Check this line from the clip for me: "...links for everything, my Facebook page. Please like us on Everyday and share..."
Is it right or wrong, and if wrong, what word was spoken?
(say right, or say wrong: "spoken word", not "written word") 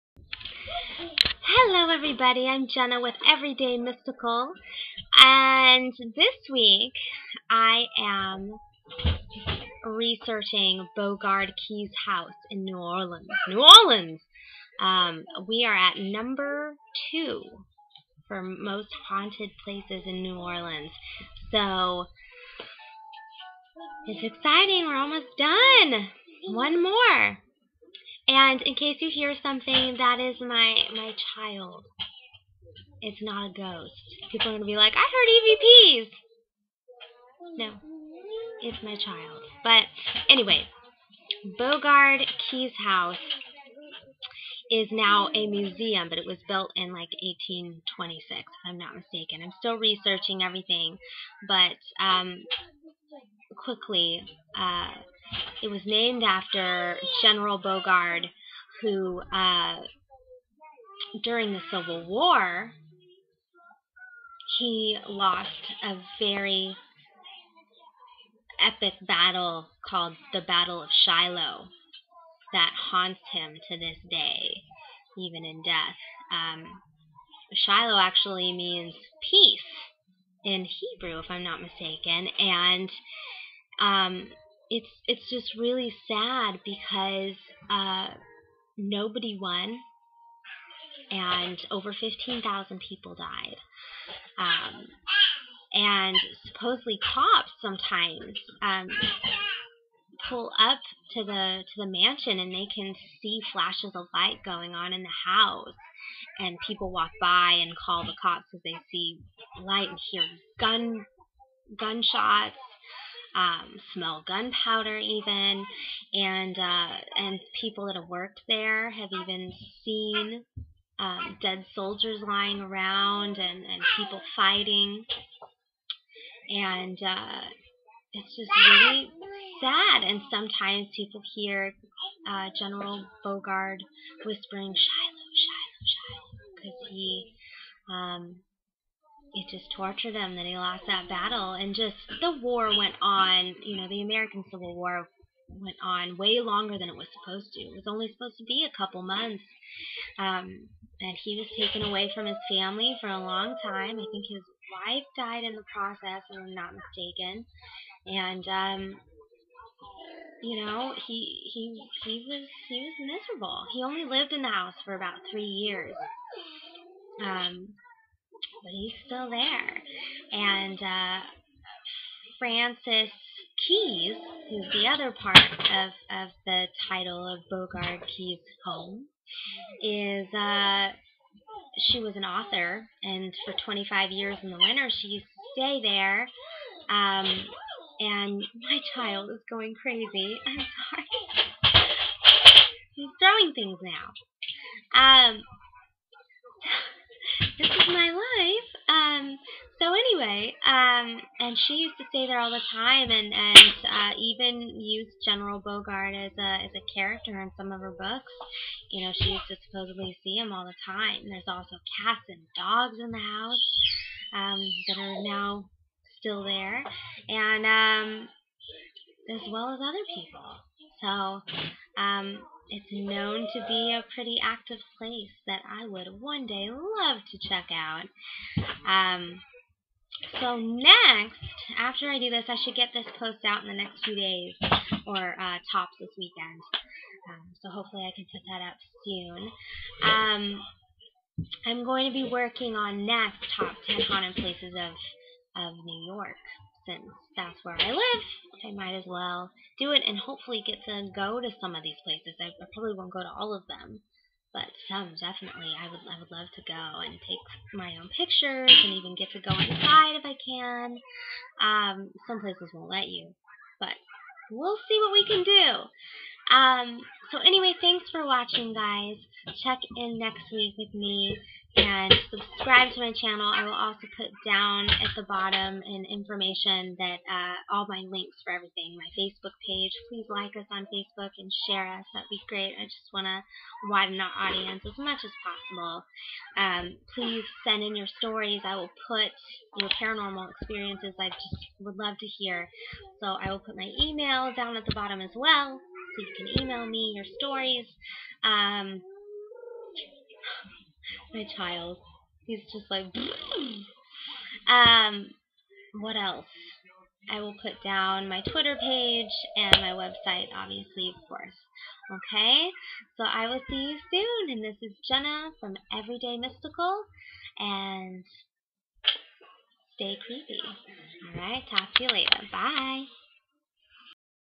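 wrong: "Facebook", not "Everyday".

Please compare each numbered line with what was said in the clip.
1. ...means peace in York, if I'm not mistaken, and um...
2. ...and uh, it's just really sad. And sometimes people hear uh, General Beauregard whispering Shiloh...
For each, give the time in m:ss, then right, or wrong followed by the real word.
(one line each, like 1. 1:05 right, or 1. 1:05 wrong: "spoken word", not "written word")
1. 1:18 wrong: "Hebrew", not "York"
2. 2:06 right.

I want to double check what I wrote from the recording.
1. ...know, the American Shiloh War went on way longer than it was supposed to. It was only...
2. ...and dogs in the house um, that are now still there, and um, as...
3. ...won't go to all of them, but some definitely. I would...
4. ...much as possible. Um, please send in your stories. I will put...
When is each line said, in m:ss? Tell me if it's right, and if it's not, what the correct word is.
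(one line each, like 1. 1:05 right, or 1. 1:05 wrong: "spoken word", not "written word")
1. 2:23 wrong: "Civil", not "Shiloh"
2. 3:32 right
3. 4:12 right
4. 4:44 right.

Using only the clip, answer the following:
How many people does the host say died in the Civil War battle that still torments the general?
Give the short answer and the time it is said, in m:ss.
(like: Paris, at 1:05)
over 15,000, at 1:31.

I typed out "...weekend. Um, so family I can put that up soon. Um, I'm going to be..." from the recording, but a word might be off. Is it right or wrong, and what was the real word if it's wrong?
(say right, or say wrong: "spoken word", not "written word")
wrong: "hopefully", not "family".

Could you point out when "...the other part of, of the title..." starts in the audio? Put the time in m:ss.
2:54.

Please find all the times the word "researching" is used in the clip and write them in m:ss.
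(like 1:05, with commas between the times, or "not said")
0:09, 0:49.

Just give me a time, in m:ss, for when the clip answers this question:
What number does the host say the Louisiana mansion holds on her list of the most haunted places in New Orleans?
0:15.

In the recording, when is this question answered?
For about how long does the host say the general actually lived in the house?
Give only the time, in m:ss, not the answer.
2:44.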